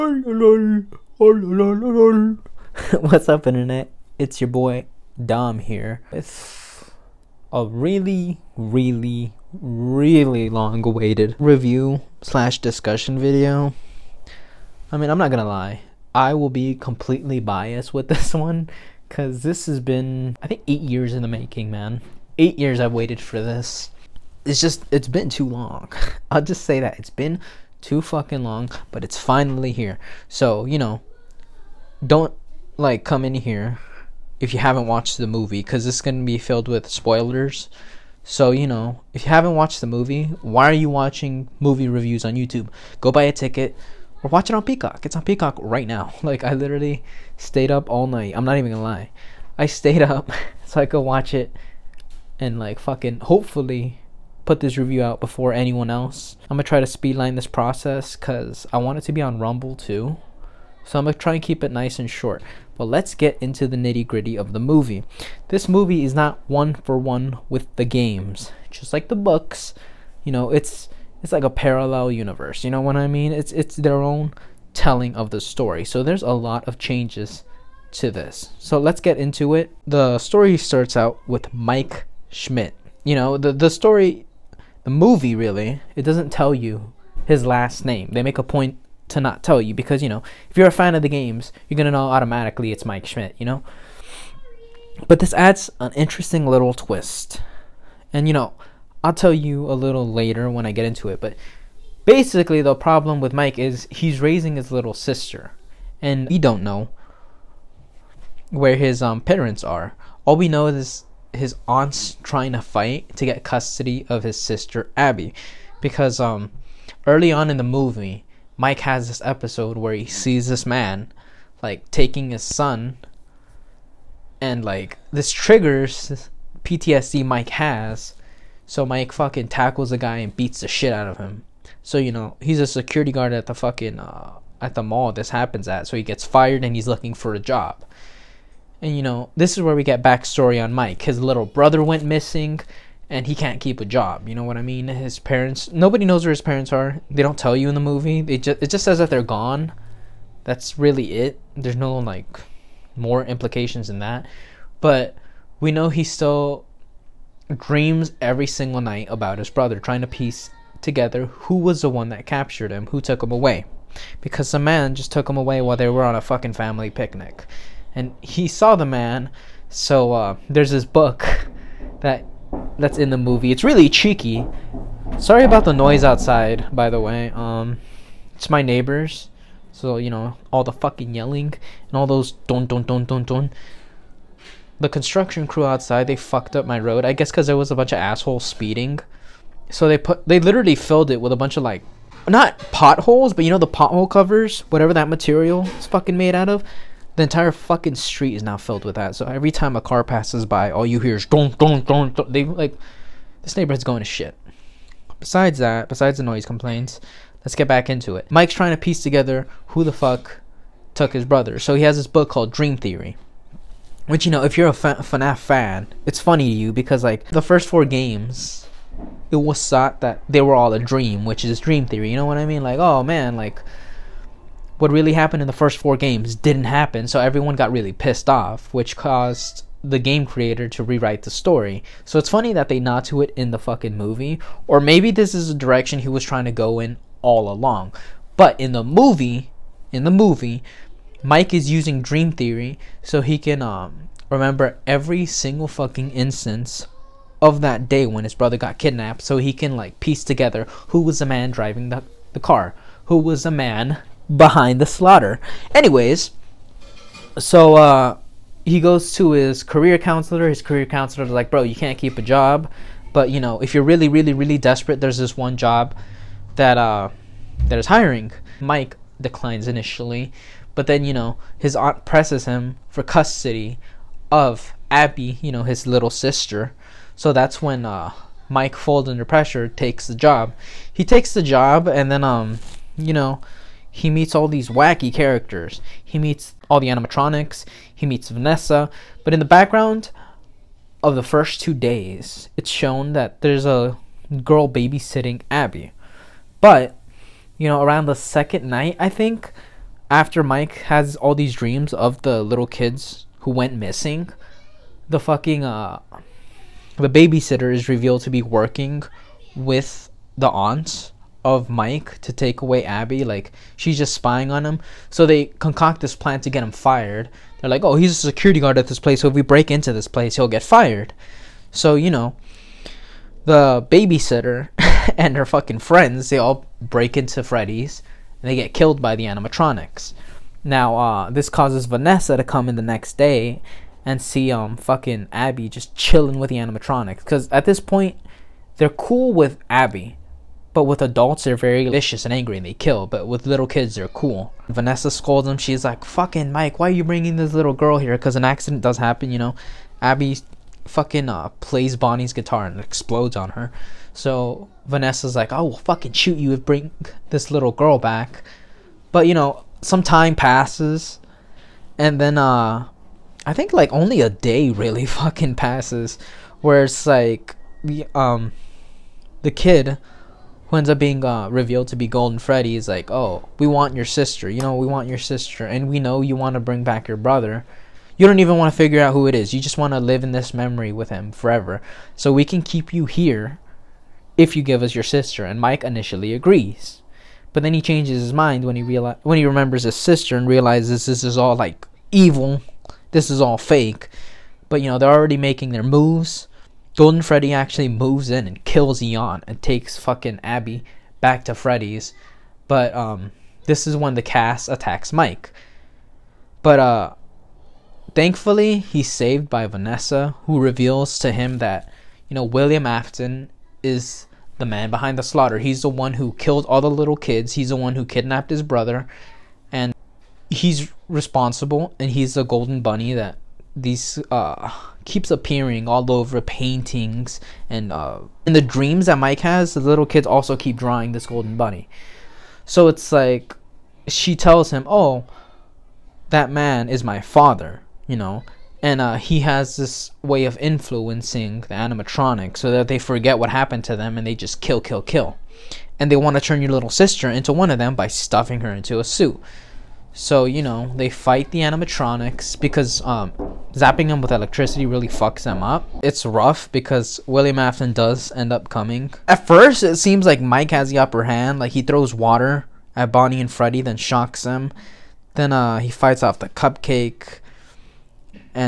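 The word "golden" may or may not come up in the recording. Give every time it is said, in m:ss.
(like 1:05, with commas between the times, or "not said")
6:12, 6:36, 7:02, 7:11.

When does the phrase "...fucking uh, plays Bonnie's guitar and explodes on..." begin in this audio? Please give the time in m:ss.
5:50.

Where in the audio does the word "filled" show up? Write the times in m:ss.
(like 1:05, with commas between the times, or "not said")
0:36, 3:10, 3:18.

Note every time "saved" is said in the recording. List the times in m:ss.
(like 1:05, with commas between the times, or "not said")
6:49.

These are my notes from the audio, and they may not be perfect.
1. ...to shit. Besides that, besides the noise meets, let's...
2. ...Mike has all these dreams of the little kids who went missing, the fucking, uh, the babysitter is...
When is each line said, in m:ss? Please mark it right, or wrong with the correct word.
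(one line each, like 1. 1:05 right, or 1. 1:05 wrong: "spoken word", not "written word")
1. 3:23 wrong: "complaints", not "meets"
2. 5:00 right.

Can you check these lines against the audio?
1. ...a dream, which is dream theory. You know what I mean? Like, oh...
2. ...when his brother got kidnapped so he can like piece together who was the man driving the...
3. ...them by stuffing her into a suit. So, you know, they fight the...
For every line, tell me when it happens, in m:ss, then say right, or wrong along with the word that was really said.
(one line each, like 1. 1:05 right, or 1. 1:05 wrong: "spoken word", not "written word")
1. 3:40 right
2. 4:08 right
3. 7:27 right.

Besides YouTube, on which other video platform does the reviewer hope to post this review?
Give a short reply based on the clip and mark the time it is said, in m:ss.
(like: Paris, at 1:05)
Rumble, at 0:59.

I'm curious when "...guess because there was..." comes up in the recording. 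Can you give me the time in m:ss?
3:07.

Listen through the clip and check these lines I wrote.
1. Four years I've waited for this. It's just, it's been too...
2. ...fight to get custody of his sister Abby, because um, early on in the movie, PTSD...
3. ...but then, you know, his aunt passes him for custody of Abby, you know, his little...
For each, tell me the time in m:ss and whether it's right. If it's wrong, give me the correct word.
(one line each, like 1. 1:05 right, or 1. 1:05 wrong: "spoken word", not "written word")
1. 0:22 wrong: "Eight", not "Four"
2. 1:52 wrong: "Mike", not "PTSD"
3. 4:30 wrong: "presses", not "passes".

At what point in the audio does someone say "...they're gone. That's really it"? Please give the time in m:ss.
2:29.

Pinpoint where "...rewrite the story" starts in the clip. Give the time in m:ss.
3:50.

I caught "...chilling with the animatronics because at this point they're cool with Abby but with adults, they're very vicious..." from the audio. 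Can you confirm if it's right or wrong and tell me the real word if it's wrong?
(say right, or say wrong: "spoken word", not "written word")
right.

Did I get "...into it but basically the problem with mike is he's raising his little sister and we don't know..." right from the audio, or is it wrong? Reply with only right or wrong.
right.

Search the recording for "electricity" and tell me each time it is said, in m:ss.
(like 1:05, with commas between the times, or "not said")
7:34.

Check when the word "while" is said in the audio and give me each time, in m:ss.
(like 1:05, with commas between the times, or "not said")
2:45.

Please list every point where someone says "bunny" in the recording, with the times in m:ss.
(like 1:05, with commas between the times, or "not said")
7:02, 7:11.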